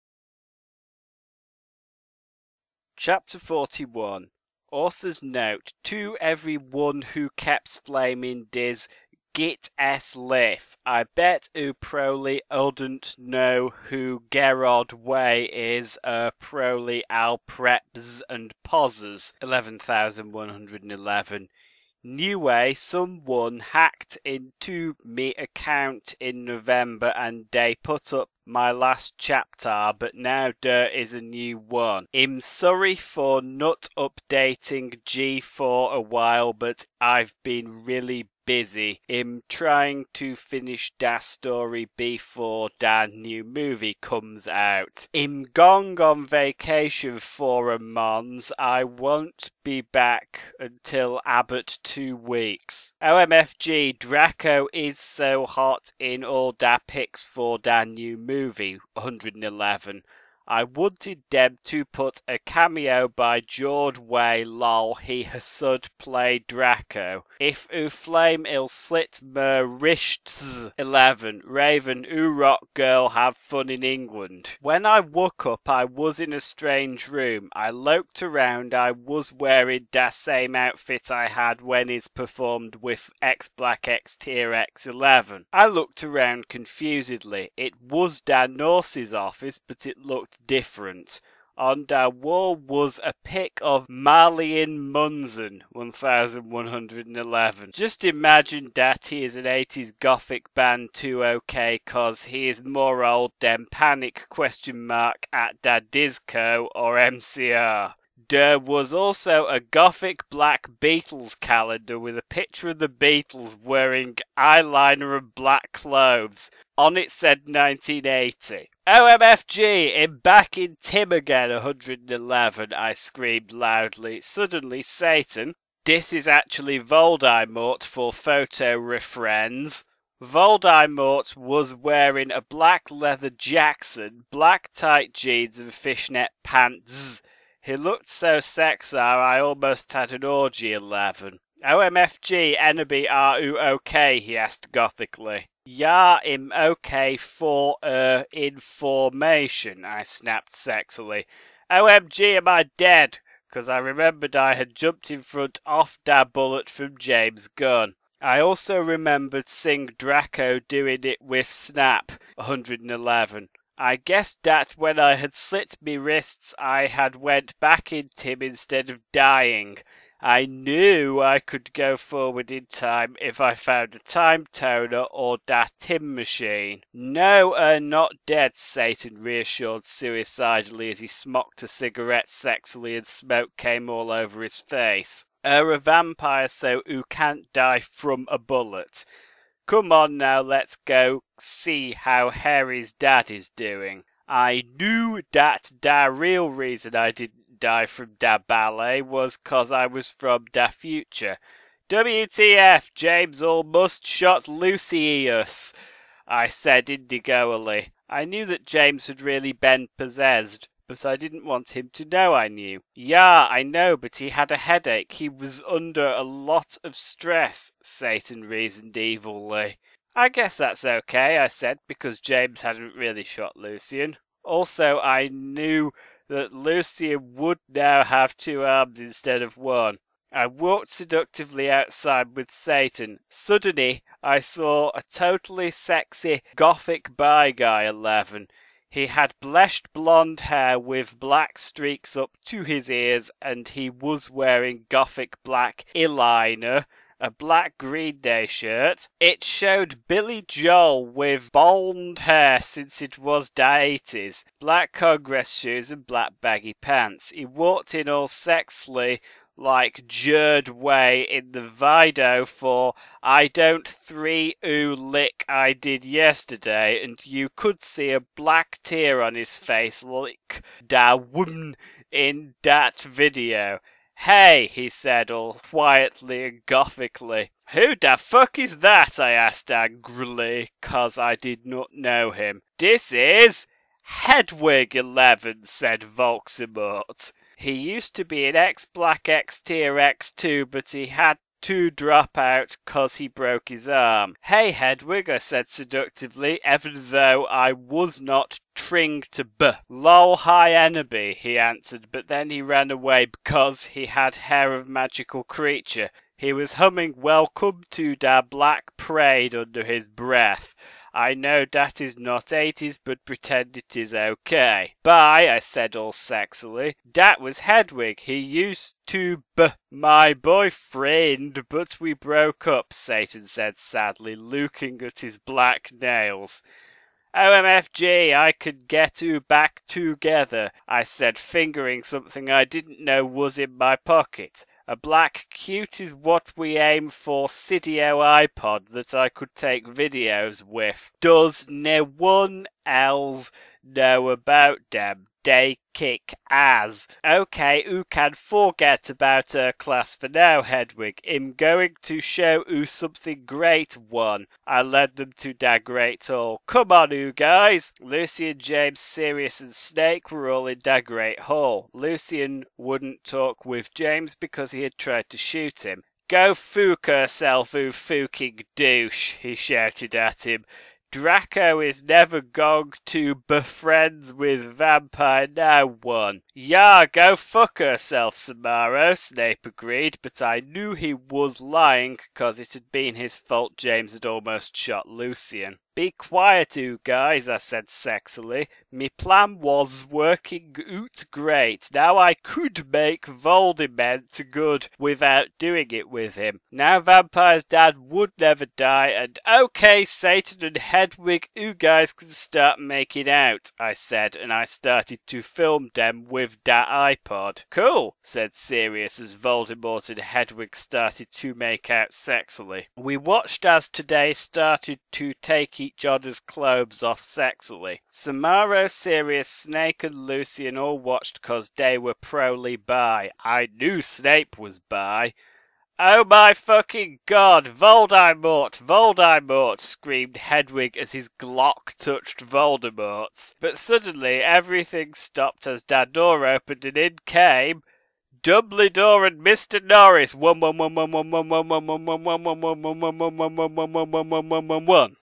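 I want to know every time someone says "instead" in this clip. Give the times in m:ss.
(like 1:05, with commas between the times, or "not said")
2:48, 3:49.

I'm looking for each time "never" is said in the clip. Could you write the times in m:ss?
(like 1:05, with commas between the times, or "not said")
6:12, 6:38.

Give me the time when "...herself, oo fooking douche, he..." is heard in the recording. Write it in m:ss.
6:07.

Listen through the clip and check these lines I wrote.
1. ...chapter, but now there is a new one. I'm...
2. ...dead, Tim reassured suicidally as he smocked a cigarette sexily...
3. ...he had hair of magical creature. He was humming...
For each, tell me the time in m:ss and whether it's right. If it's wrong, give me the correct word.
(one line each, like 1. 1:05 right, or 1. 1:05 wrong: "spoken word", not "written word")
1. 0:29 right
2. 2:58 wrong: "Satan", not "Tim"
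3. 5:03 right.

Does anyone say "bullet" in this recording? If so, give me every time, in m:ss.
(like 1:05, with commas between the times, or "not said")
2:36, 3:08.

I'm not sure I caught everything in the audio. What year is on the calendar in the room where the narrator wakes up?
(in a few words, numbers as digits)
1980.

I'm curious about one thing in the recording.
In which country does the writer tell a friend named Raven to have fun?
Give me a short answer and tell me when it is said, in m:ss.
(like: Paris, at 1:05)
England, at 1:13.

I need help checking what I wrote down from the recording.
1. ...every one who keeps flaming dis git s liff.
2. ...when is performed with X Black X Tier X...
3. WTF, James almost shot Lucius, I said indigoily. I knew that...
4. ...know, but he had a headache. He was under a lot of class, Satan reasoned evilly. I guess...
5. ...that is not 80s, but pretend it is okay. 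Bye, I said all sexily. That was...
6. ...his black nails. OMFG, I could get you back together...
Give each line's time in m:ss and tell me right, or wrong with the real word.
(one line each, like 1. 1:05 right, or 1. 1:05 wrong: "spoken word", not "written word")
1. 0:06 right
2. 1:21 right
3. 3:21 right
4. 3:33 wrong: "stress", not "class"
5. 5:11 right
6. 5:25 right.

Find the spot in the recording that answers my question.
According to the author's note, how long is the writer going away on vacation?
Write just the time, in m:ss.
0:47.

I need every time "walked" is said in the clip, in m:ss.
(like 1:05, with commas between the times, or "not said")
3:50, 4:17.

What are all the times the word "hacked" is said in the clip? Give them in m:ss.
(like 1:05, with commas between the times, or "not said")
0:23.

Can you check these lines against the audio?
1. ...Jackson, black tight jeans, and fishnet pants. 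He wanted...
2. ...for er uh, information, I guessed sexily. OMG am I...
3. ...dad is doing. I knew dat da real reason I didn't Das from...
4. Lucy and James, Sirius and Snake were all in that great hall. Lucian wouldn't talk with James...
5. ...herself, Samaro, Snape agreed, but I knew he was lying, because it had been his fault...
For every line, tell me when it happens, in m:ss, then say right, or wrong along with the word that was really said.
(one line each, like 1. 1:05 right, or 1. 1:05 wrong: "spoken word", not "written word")
1. 2:13 wrong: "looked", not "wanted"
2. 2:27 wrong: "snapped", not "guessed"
3. 3:12 wrong: "Die", not "Das"
4. 5:57 right
5. 6:17 right.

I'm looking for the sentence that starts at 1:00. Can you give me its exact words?
I wanted Deb to put a cameo by Jord Way lol he hasud play Draco.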